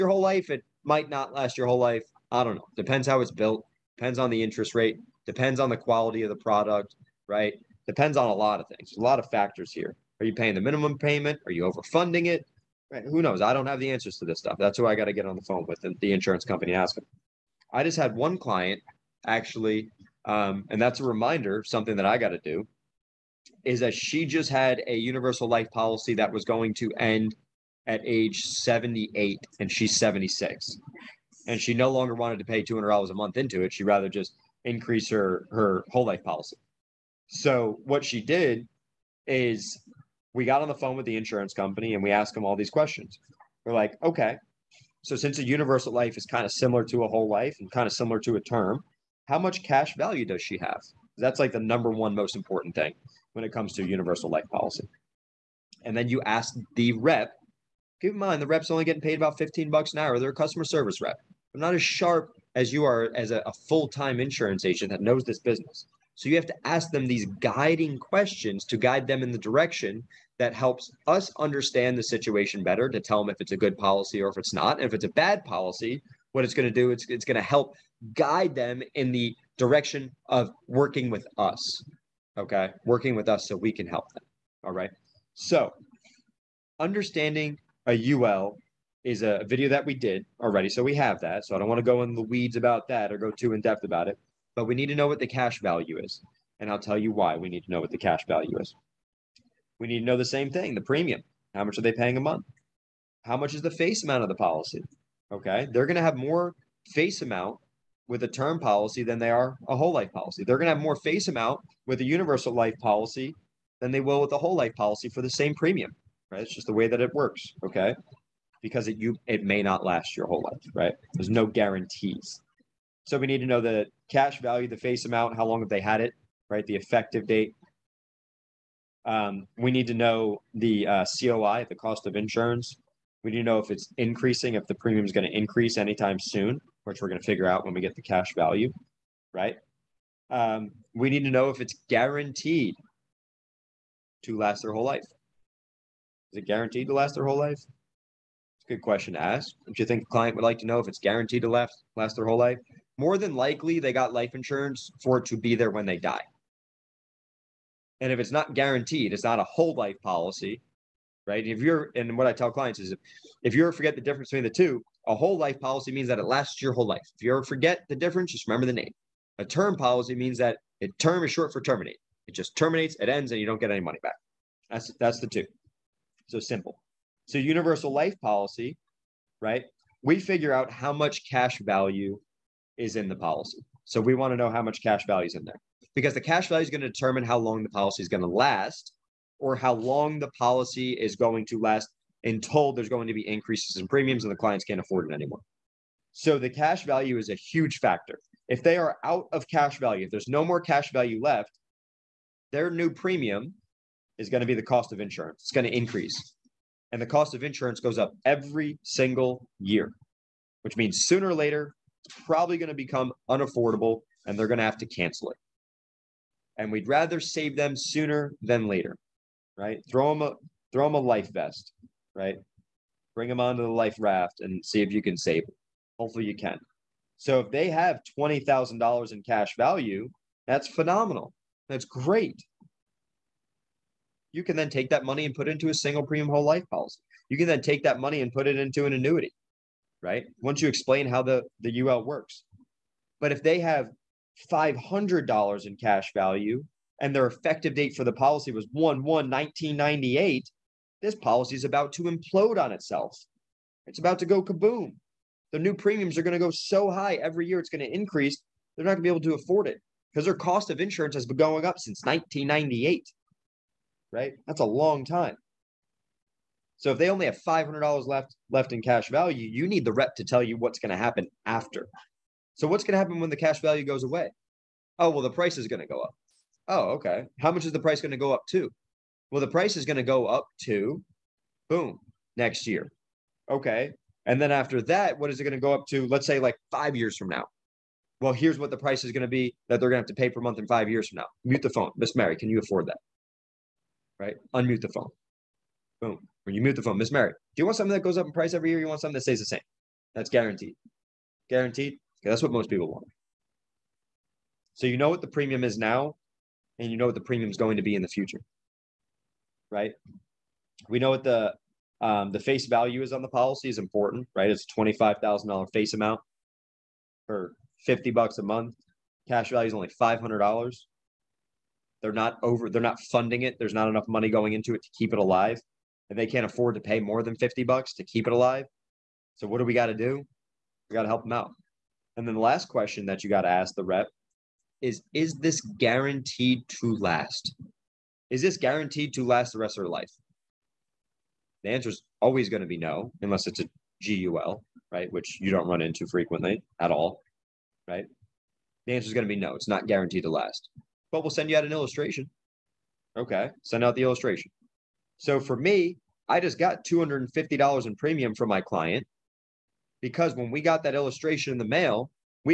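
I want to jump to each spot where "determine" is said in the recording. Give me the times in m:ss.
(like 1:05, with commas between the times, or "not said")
3:06.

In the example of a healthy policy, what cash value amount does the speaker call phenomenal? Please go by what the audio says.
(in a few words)
$20,000.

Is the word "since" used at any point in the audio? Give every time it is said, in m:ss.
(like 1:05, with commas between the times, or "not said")
0:45, 4:21.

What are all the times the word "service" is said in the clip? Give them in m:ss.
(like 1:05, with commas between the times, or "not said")
1:00.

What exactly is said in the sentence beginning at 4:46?
Let's say like 5 years from now.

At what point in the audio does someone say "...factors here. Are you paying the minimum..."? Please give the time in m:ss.
0:09.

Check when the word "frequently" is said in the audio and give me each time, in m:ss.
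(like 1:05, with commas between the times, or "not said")
5:46.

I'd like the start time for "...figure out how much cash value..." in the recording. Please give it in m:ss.
3:00.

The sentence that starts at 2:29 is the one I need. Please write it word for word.
Don't you think a client would like to know if it's guaranteed to last last their whole life?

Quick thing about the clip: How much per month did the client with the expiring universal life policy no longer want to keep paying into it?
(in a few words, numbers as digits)
$200.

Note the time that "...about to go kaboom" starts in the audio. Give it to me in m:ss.
4:13.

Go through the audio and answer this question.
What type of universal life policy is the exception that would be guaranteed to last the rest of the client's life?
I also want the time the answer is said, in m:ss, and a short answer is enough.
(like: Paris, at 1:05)
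GUL, at 5:44.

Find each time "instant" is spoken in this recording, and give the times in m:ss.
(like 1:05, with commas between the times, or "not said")
not said.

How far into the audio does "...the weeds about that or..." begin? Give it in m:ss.
1:32.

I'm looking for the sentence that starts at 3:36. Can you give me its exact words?
And we'd rather save them sooner than later, right?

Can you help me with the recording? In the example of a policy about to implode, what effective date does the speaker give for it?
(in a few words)
1/1/1998.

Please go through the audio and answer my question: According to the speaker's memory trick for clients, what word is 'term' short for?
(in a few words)
terminate.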